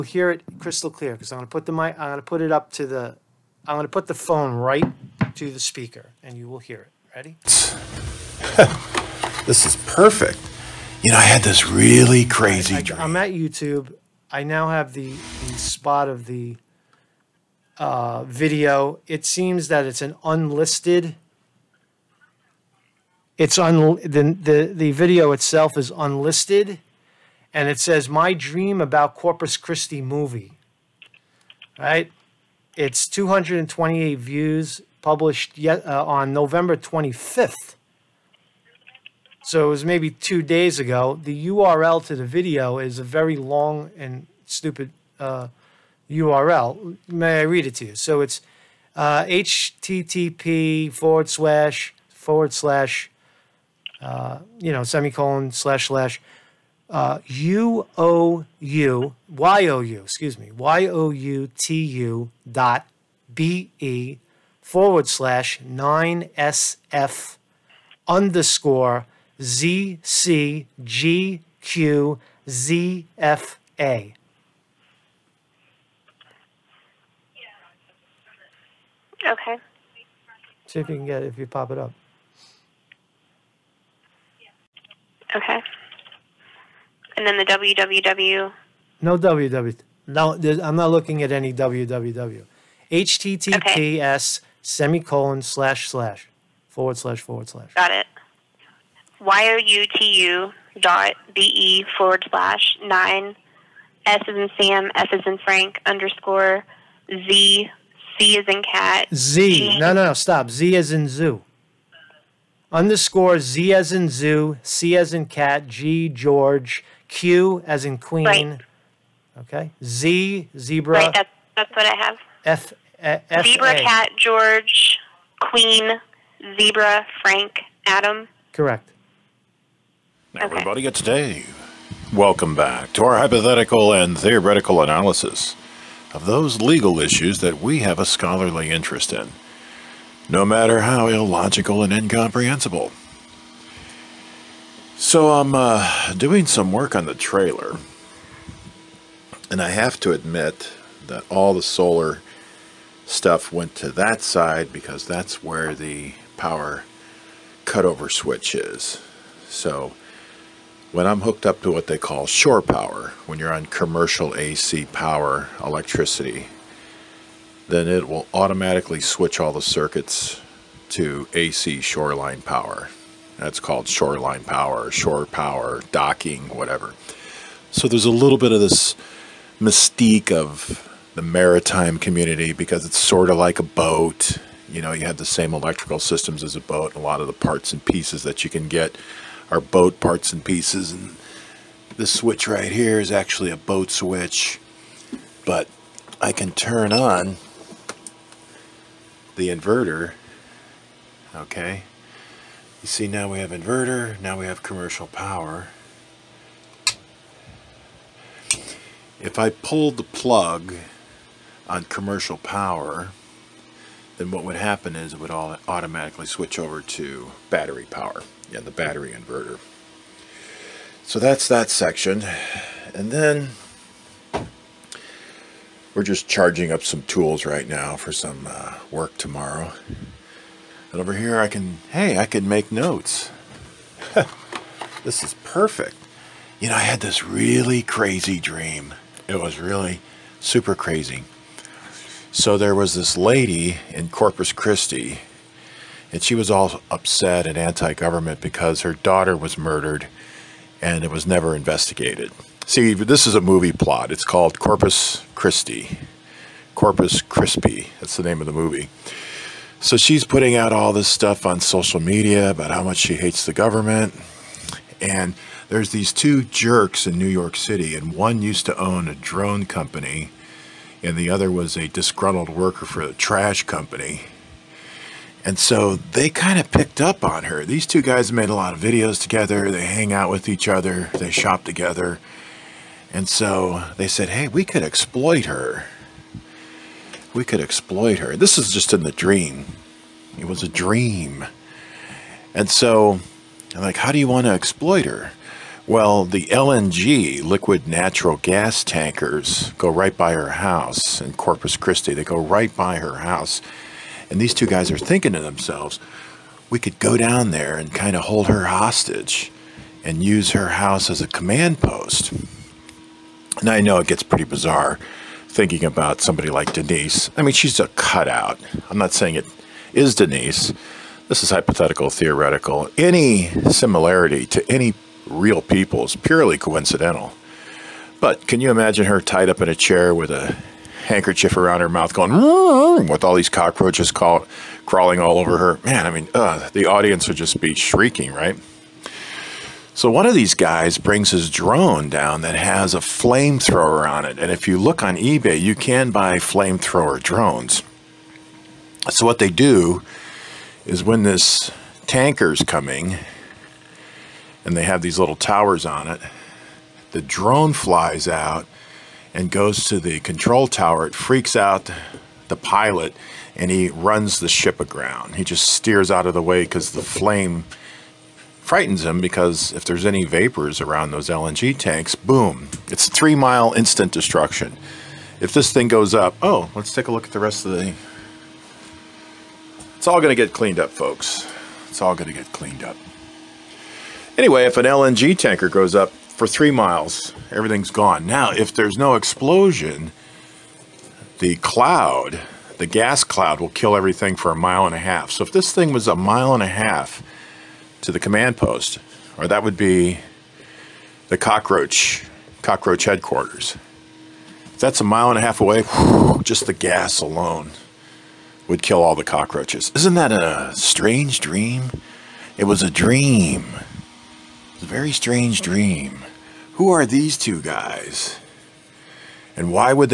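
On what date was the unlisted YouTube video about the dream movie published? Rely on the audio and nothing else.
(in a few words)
November 25th.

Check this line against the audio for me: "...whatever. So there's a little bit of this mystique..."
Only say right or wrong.
right.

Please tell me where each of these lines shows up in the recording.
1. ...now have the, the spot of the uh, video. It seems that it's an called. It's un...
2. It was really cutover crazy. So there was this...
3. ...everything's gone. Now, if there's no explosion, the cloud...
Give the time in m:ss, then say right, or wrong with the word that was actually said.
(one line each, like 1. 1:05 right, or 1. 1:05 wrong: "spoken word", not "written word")
1. 0:14 wrong: "unlisted", not "called"
2. 3:59 wrong: "super", not "cutover"
3. 6:27 right.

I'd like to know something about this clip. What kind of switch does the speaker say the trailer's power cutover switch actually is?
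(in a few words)
a boat switch.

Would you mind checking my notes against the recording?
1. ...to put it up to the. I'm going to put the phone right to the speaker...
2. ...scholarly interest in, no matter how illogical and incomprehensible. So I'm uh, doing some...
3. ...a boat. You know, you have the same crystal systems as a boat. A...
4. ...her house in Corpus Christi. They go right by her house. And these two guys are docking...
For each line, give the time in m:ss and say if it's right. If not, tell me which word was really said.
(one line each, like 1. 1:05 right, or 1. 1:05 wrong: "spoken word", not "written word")
1. 0:02 right
2. 2:18 right
3. 3:03 wrong: "electrical", not "crystal"
4. 5:00 wrong: "thinking", not "docking".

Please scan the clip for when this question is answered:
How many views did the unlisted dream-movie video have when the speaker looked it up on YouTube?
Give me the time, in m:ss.
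0:33.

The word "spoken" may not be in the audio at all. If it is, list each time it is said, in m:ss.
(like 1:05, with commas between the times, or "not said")
not said.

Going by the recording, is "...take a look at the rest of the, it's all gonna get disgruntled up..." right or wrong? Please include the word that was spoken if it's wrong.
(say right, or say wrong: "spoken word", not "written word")
wrong: "cleaned", not "disgruntled".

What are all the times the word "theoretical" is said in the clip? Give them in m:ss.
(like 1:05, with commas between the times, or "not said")
2:14, 5:22.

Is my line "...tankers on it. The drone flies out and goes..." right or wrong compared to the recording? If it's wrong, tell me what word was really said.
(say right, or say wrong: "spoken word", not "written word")
wrong: "towers", not "tankers".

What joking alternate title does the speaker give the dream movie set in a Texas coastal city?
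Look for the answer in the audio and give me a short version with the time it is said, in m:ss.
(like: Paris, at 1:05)
Corpus Crispy, at 4:16.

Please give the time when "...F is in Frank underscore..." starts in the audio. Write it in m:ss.
1:44.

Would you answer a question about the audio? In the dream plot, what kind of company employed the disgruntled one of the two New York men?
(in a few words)
a trash company.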